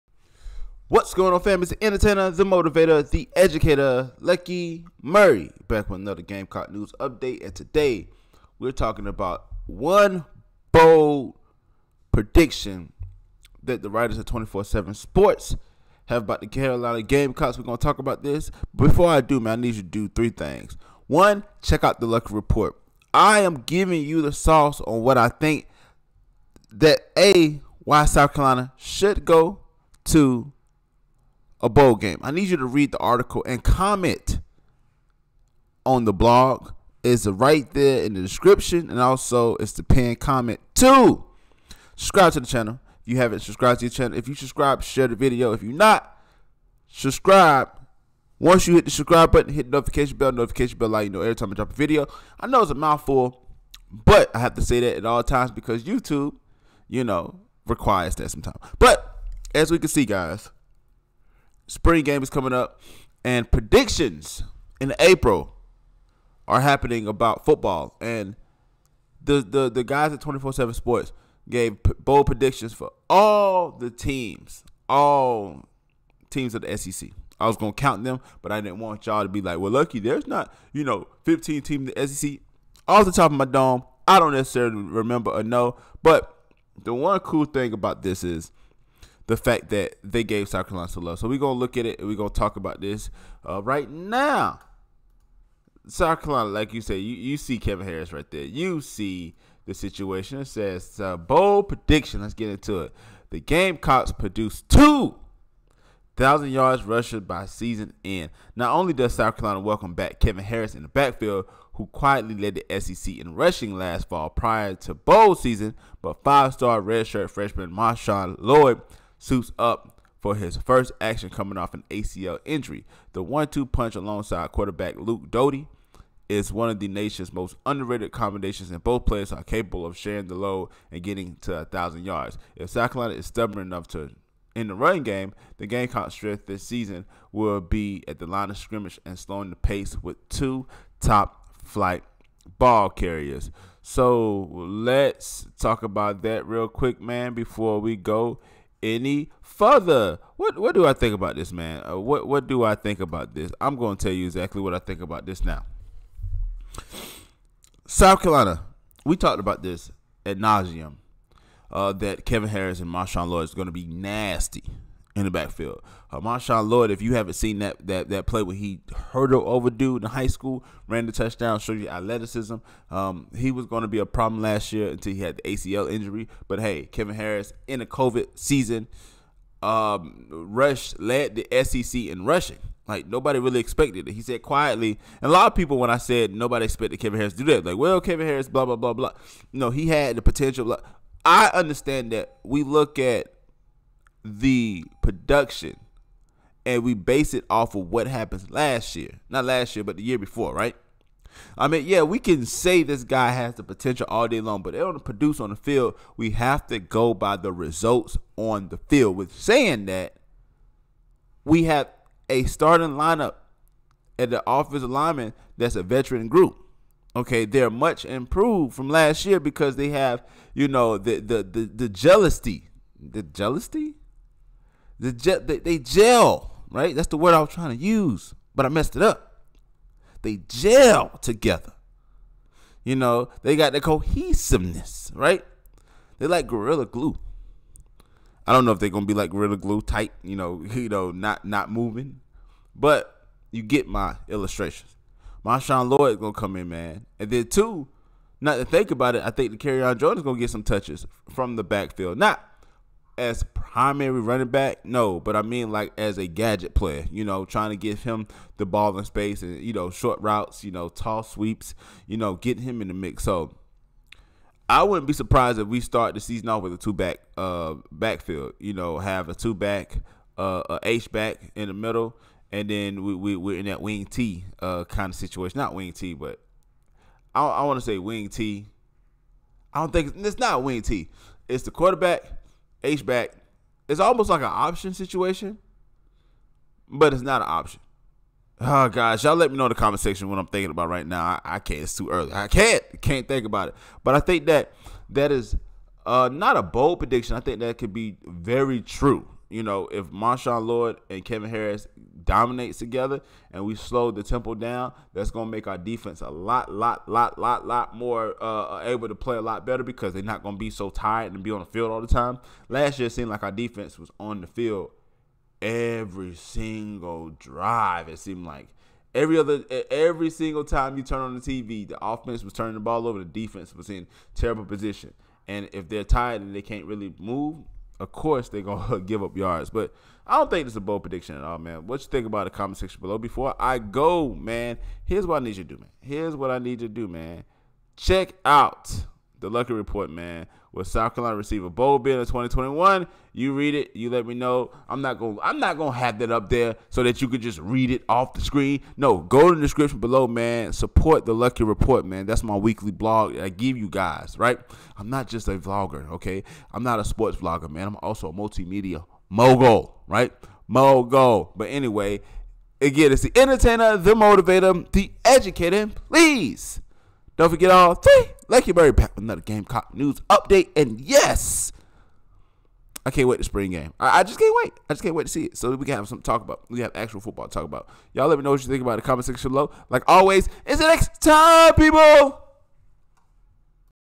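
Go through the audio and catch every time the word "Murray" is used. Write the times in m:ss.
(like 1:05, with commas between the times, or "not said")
0:05, 6:08.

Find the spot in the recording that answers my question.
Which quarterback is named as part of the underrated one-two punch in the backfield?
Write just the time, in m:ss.
2:04.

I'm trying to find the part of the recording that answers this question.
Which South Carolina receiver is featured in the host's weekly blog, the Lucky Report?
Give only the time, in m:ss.
5:41.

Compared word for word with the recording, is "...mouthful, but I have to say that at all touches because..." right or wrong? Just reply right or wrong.
wrong.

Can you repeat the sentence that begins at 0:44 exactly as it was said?
If you subscribe, share the video.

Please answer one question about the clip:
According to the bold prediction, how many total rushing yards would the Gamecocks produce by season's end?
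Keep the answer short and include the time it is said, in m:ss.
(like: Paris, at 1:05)
2000, at 1:44.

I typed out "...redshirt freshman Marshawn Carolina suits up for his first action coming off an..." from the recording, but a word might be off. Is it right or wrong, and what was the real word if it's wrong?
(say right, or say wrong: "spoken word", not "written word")
wrong: "Lloyd", not "Carolina".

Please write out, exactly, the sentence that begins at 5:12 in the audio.
Last year, it seemed like our defense was on the field every single drive.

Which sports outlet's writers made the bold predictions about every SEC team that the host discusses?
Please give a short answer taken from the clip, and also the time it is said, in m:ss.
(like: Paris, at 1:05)
24/7 Sports, at 0:14.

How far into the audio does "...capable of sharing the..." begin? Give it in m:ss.
2:09.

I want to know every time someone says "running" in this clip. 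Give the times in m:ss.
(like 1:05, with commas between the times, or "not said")
2:14, 4:14.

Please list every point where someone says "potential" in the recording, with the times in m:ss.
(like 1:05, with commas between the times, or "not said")
3:10, 3:23.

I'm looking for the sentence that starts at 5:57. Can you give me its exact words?
I'm also a multimedia mogul, right?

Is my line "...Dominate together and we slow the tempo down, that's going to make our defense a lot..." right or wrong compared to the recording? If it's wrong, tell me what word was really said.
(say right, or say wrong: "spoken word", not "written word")
right.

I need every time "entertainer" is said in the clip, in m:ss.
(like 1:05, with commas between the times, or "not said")
0:01, 6:03.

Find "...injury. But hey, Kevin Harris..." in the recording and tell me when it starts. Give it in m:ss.
2:55.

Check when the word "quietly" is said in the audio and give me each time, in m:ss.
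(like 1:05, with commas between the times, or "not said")
1:51, 3:04.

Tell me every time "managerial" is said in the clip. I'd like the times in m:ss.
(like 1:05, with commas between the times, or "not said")
not said.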